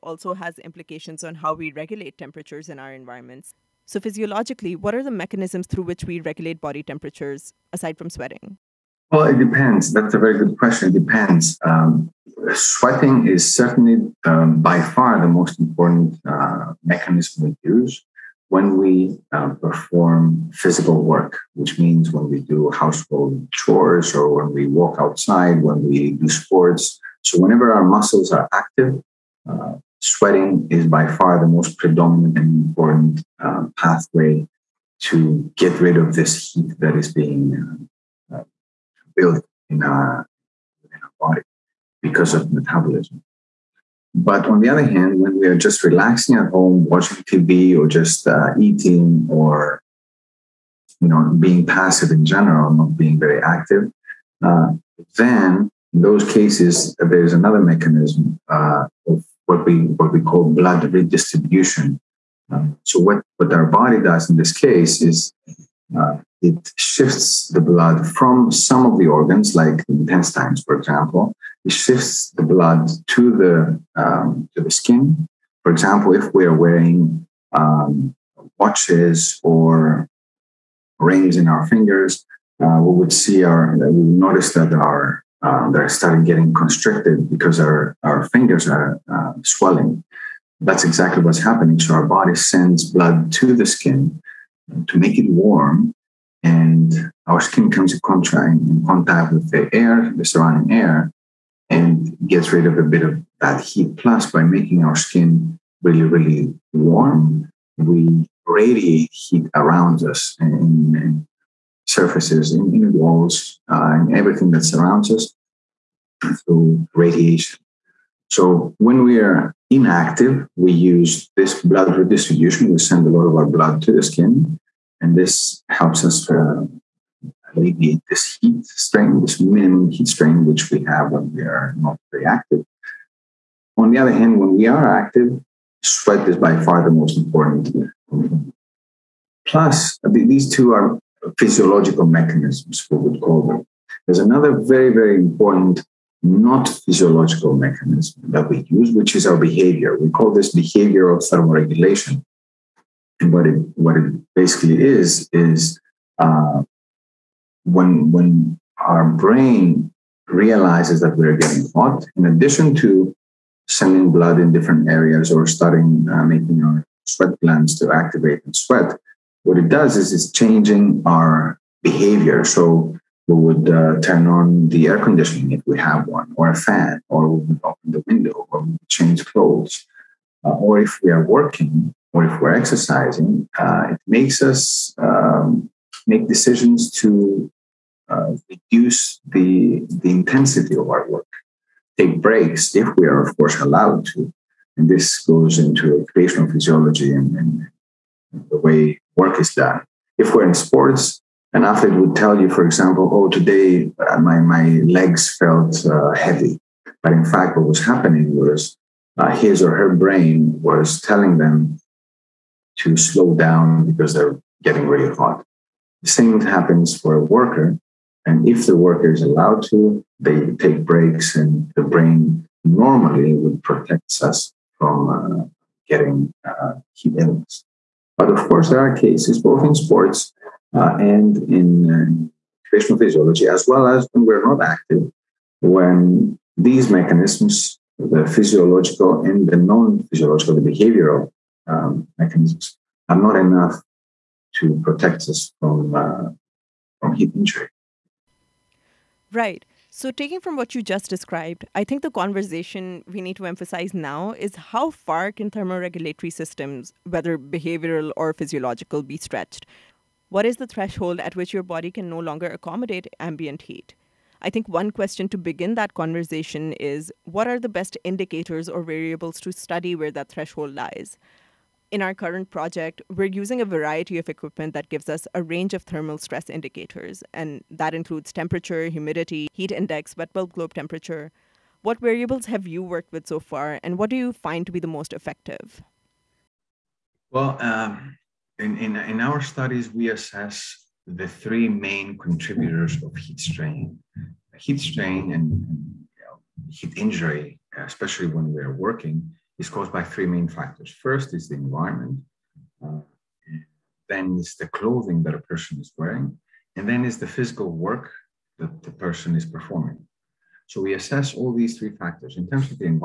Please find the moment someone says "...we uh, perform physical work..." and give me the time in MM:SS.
00:18.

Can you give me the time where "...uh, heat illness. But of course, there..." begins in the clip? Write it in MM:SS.
03:46.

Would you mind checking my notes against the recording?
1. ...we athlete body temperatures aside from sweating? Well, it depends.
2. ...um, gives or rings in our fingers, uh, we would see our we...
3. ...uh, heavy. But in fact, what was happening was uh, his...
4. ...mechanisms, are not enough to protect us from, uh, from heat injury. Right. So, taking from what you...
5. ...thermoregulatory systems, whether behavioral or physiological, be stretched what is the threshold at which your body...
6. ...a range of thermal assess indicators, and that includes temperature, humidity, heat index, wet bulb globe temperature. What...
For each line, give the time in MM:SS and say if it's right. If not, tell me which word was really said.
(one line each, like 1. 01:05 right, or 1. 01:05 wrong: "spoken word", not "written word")
1. 00:06 wrong: "regulate", not "athlete"
2. 01:17 wrong: "watches", not "gives"
3. 03:25 right
4. 04:02 right
5. 04:15 right
6. 04:35 wrong: "stress", not "assess".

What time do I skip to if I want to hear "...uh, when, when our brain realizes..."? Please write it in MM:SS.
02:36.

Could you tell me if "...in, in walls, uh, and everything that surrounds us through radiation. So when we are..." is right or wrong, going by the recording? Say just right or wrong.
right.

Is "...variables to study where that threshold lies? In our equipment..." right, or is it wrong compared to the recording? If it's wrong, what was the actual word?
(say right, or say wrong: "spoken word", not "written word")
wrong: "current", not "equipment".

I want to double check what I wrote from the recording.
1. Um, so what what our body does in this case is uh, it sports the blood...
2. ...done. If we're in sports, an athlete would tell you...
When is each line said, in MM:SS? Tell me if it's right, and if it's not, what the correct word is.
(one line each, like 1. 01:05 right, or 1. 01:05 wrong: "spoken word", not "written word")
1. 01:02 wrong: "shifts", not "sports"
2. 03:19 right.